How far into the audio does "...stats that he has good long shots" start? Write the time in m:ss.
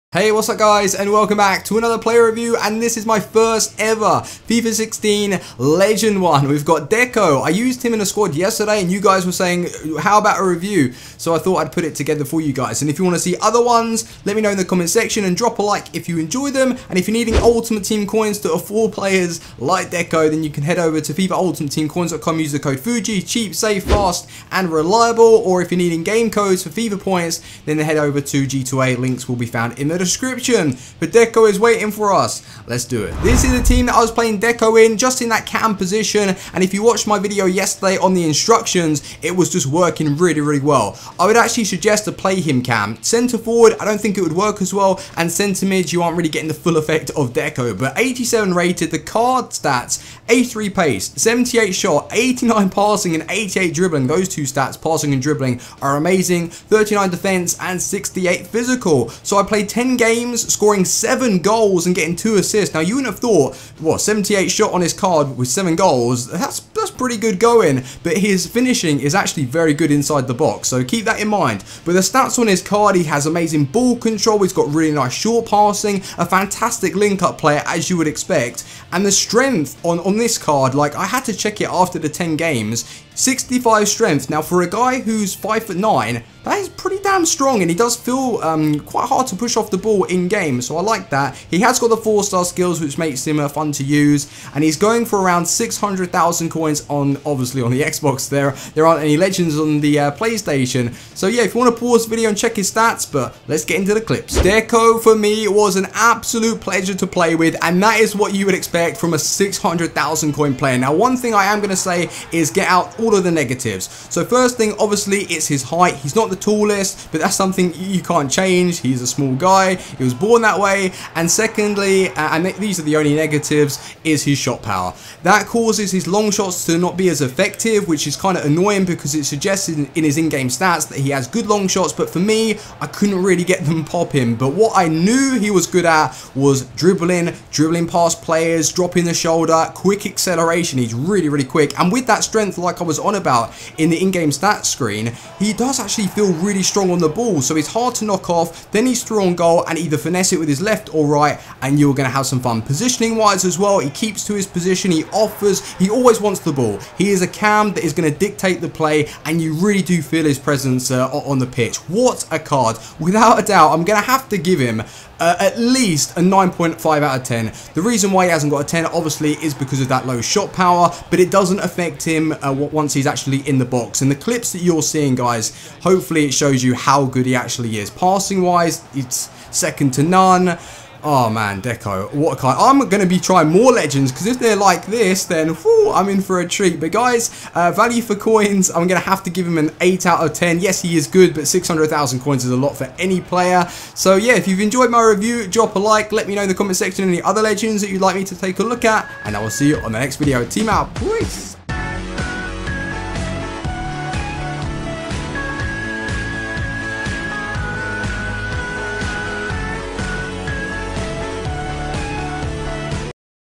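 2:10.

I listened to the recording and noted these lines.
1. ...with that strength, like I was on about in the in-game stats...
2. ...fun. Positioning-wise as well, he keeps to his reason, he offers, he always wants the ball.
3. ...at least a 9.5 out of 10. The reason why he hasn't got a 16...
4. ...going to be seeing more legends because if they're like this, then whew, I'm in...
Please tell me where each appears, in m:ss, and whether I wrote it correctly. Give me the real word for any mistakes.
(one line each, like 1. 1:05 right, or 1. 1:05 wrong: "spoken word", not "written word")
1. 2:21 right
2. 2:32 wrong: "position", not "reason"
3. 2:45 wrong: "10", not "16"
4. 3:02 wrong: "trying", not "seeing".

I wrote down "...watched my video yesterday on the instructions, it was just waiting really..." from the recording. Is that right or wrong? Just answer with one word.
wrong.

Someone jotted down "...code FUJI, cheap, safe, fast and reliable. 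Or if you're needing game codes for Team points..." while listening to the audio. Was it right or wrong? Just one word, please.
wrong.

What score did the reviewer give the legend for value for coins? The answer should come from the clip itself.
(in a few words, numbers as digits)
8 out of 10.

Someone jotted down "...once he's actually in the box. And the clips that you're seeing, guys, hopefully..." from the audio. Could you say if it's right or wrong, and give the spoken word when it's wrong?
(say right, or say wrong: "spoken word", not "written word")
right.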